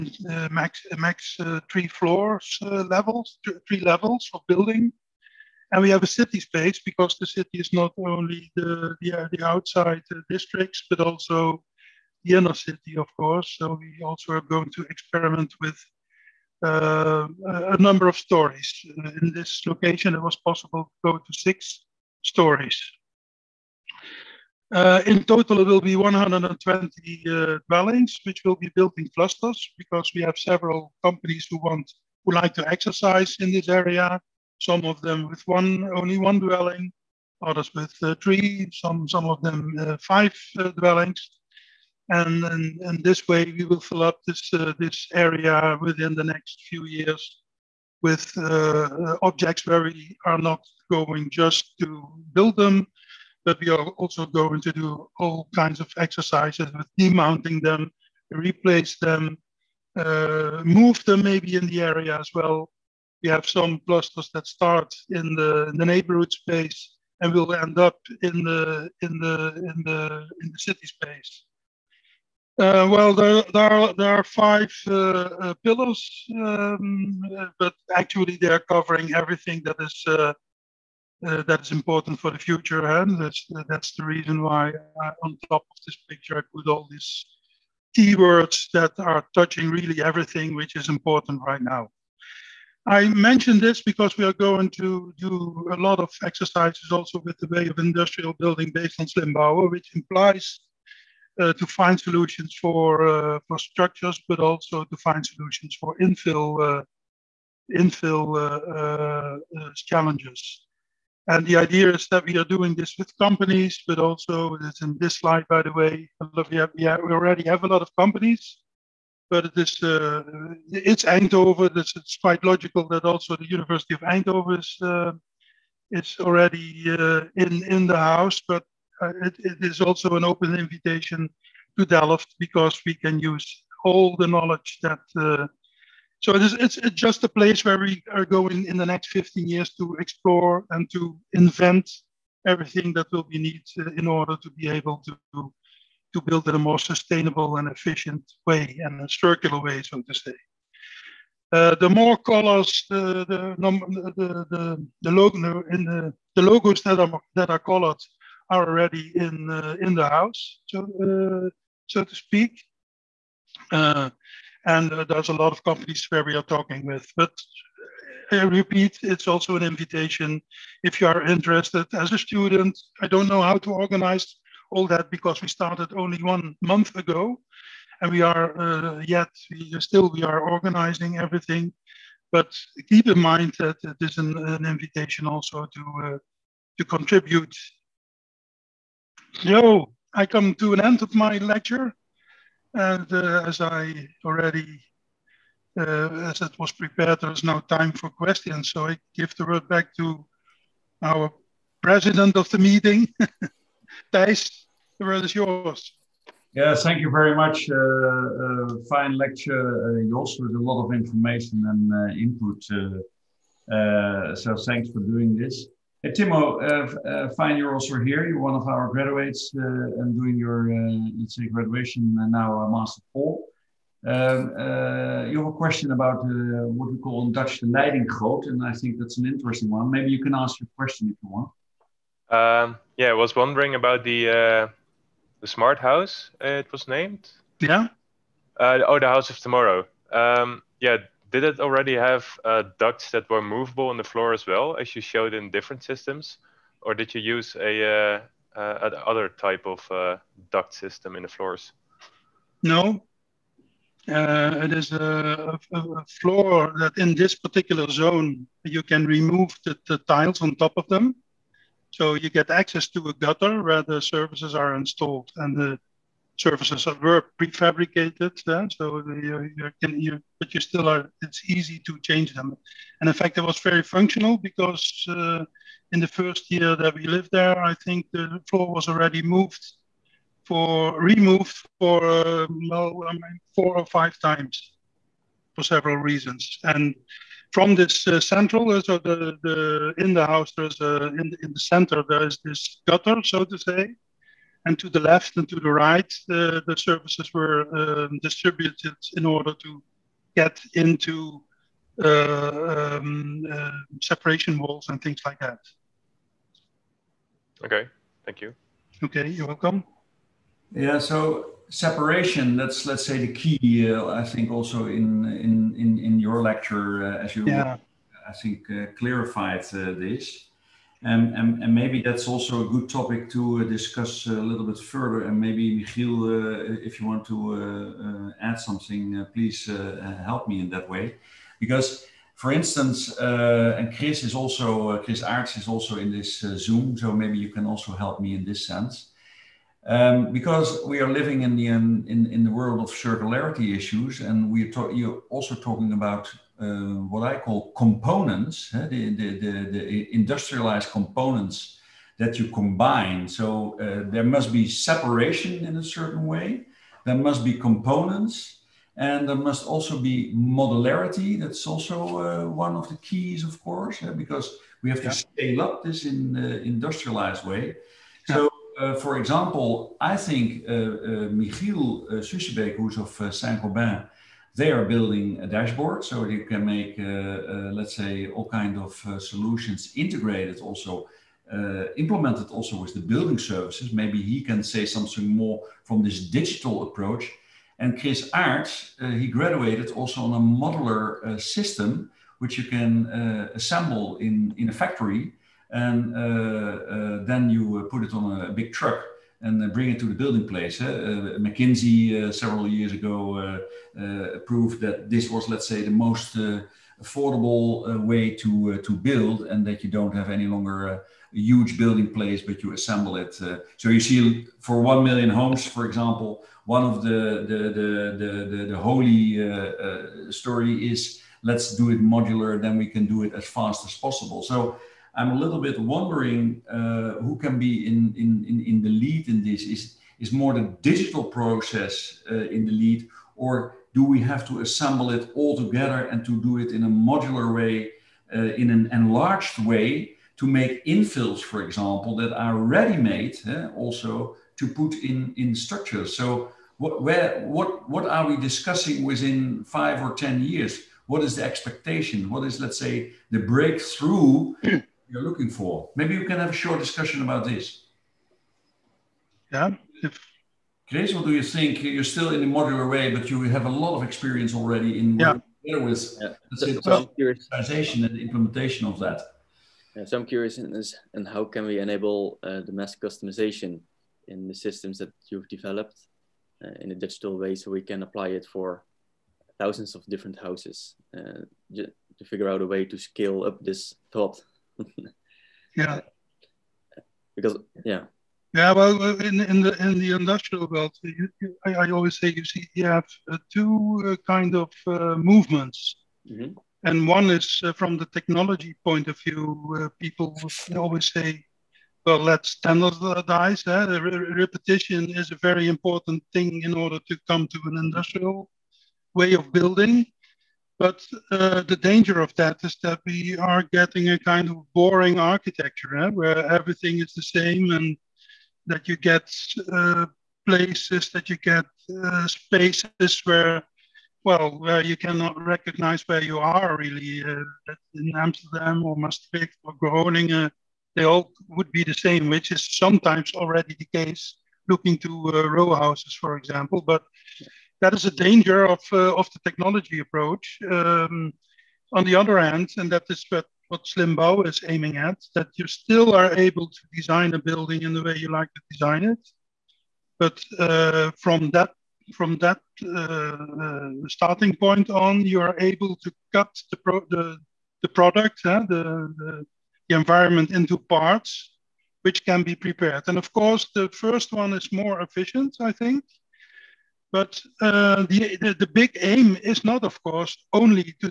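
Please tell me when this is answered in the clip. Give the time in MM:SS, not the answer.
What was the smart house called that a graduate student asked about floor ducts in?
03:58.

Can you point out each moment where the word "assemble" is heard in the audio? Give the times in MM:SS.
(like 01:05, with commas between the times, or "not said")
06:33, 06:52, 07:14.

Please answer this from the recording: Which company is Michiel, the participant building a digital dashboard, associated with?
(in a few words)
Saint-Gobain.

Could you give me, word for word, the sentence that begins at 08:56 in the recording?
But yeah that is a danger of, uh, of the technology approach.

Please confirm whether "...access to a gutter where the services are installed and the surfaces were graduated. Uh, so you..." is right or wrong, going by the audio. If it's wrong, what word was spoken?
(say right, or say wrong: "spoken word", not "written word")
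wrong: "prefabricated", not "graduated".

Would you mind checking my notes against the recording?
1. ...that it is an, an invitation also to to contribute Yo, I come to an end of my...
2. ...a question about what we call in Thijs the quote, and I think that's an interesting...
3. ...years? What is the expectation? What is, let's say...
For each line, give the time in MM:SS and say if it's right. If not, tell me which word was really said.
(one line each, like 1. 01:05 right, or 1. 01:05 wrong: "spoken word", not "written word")
1. 03:03 right
2. 03:45 wrong: "Dutch", not "Thijs"
3. 07:30 right.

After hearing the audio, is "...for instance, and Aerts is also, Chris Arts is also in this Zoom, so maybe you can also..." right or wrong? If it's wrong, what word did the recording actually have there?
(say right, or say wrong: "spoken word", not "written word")
wrong: "Chris", not "Aerts".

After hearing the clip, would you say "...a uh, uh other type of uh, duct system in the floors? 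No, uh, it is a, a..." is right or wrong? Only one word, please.
right.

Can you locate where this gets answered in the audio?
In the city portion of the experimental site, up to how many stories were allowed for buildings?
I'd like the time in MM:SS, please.
00:21.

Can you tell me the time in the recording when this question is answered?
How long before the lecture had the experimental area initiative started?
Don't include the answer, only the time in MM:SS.
02:56.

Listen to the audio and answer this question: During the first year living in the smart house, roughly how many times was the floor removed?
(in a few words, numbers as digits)
4 or 5.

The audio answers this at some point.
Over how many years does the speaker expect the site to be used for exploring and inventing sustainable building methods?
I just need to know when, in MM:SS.
02:19.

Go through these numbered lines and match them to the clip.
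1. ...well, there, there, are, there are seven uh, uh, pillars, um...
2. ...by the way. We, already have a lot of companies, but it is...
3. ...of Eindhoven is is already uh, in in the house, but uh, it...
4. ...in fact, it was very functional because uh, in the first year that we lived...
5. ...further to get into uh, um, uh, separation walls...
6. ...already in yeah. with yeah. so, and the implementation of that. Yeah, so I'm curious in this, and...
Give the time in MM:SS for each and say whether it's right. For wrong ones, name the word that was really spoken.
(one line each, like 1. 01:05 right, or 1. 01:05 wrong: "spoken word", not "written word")
1. 01:12 wrong: "five", not "seven"
2. 01:55 right
3. 02:03 right
4. 04:33 right
5. 04:59 wrong: "order", not "further"
6. 07:44 right.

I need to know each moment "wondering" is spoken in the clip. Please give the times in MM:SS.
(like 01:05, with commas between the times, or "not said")
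03:53, 07:05.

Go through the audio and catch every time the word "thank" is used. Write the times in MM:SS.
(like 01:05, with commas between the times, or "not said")
03:26, 03:34, 05:08.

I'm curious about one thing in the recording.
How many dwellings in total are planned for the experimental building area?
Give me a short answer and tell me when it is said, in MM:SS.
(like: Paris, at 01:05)
120, at 00:25.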